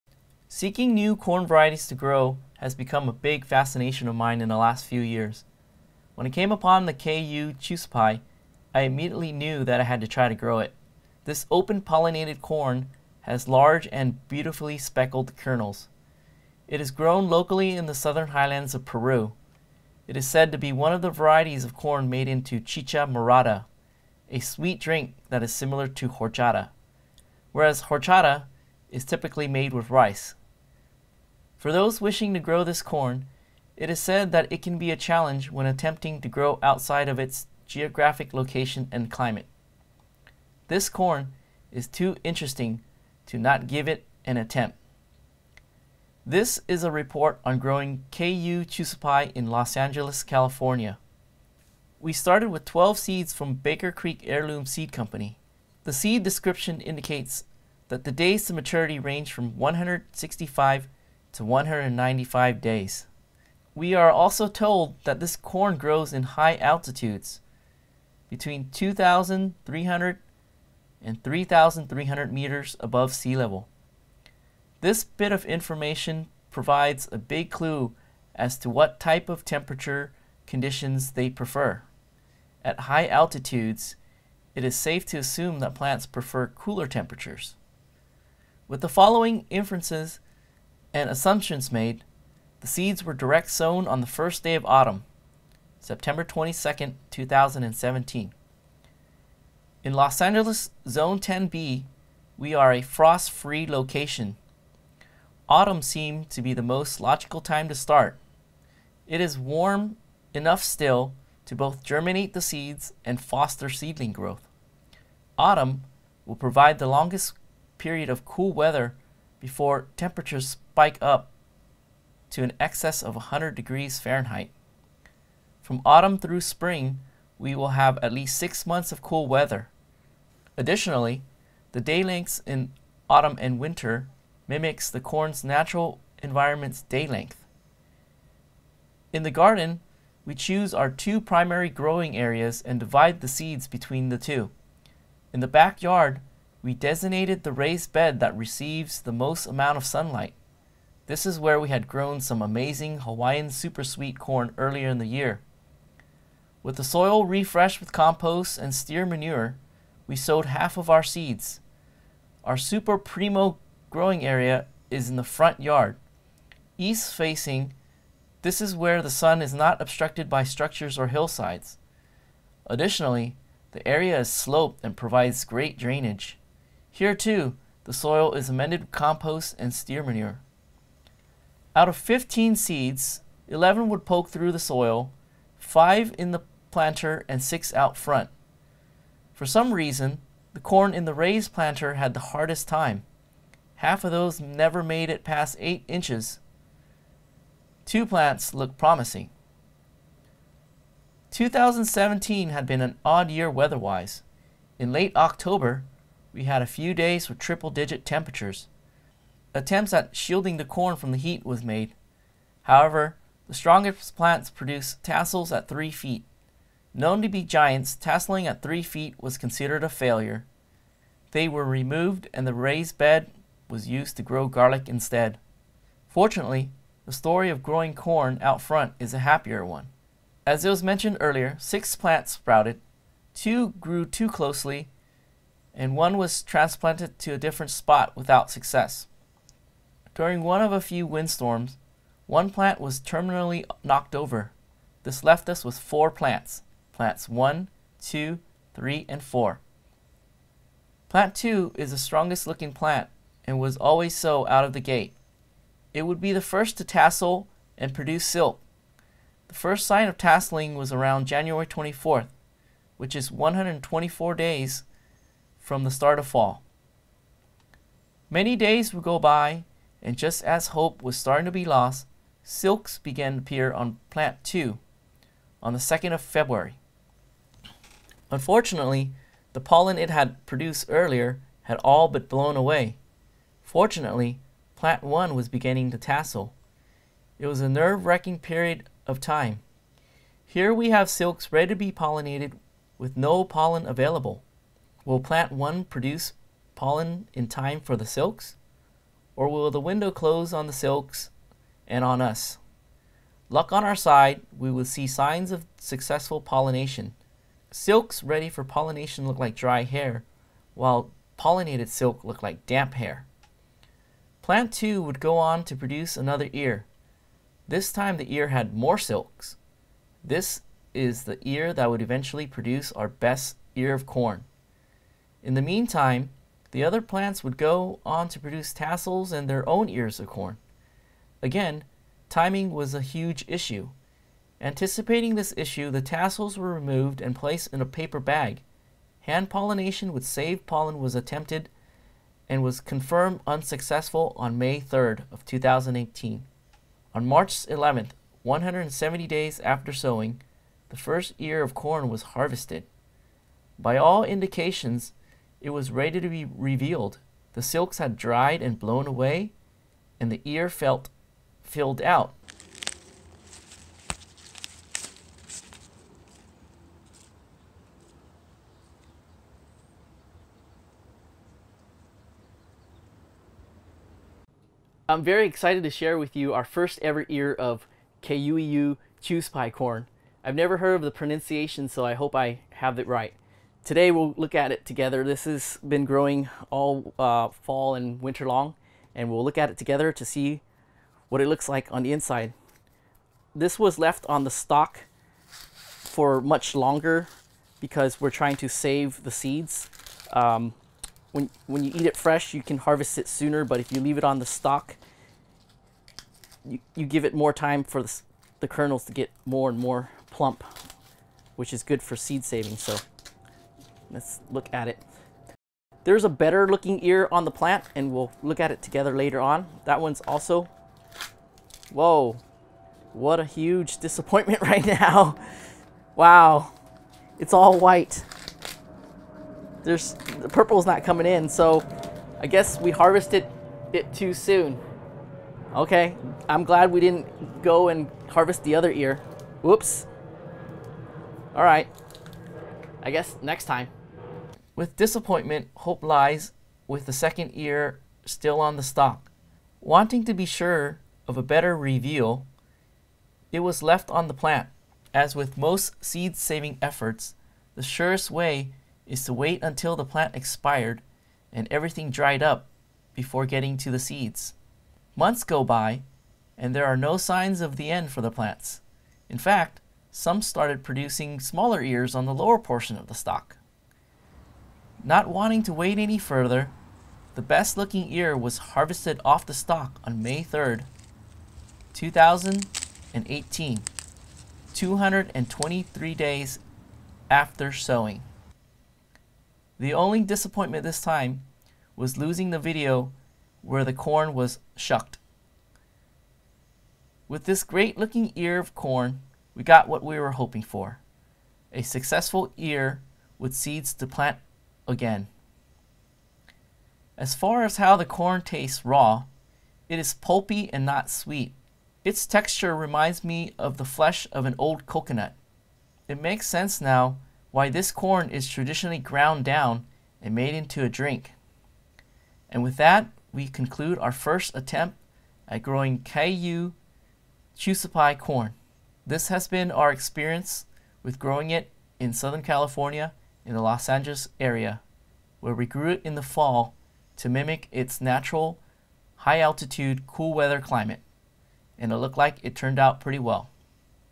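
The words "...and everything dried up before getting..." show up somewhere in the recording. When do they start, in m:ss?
7:41.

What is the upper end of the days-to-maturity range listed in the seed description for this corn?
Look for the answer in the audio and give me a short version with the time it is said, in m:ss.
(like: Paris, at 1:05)
195 days, at 1:01.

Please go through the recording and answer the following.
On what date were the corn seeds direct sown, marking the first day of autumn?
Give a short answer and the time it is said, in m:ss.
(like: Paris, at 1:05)
September 22, 2017, at 1:35.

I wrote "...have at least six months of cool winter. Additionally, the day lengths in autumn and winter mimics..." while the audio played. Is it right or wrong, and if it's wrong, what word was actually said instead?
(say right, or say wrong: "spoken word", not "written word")
wrong: "weather", not "winter".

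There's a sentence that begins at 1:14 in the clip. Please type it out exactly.
This bit of information provides a big clue as to what type of temperature conditions they prefer.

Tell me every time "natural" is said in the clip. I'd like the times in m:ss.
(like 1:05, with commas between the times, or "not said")
2:15, 8:58.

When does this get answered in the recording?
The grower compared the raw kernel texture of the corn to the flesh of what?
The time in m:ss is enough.
8:34.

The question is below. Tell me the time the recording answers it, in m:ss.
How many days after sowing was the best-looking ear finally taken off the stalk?
8:04.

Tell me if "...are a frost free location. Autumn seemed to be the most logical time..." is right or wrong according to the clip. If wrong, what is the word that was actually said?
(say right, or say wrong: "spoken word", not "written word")
right.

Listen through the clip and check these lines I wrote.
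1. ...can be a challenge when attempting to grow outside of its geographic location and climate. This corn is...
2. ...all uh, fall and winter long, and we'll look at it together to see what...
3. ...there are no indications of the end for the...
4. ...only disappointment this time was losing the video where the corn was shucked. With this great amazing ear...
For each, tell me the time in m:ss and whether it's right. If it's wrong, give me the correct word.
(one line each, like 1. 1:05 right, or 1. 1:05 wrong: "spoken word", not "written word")
1. 0:34 right
2. 6:26 right
3. 7:46 wrong: "signs", not "indications"
4. 8:09 wrong: "looking", not "amazing".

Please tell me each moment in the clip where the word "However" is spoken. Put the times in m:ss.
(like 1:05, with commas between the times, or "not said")
3:32.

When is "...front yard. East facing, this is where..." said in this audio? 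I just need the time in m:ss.
2:45.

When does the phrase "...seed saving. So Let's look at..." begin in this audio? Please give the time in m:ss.
6:52.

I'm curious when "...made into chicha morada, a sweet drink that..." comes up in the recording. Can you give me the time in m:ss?
0:22.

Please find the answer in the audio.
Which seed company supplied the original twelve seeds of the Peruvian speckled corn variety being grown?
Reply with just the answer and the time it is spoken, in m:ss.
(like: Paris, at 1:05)
Baker Creek Heirloom Seed Company, at 0:53.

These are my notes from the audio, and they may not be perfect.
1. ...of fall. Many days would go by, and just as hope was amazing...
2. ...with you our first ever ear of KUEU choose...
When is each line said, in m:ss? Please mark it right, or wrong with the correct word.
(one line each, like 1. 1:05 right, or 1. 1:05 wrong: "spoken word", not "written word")
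1. 4:26 wrong: "starting", not "amazing"
2. 6:16 right.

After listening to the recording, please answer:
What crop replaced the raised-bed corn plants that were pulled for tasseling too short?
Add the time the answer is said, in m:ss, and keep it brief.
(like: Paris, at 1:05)
Garlic, at 3:44.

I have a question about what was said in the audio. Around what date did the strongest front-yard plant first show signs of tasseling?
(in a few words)
January 24th.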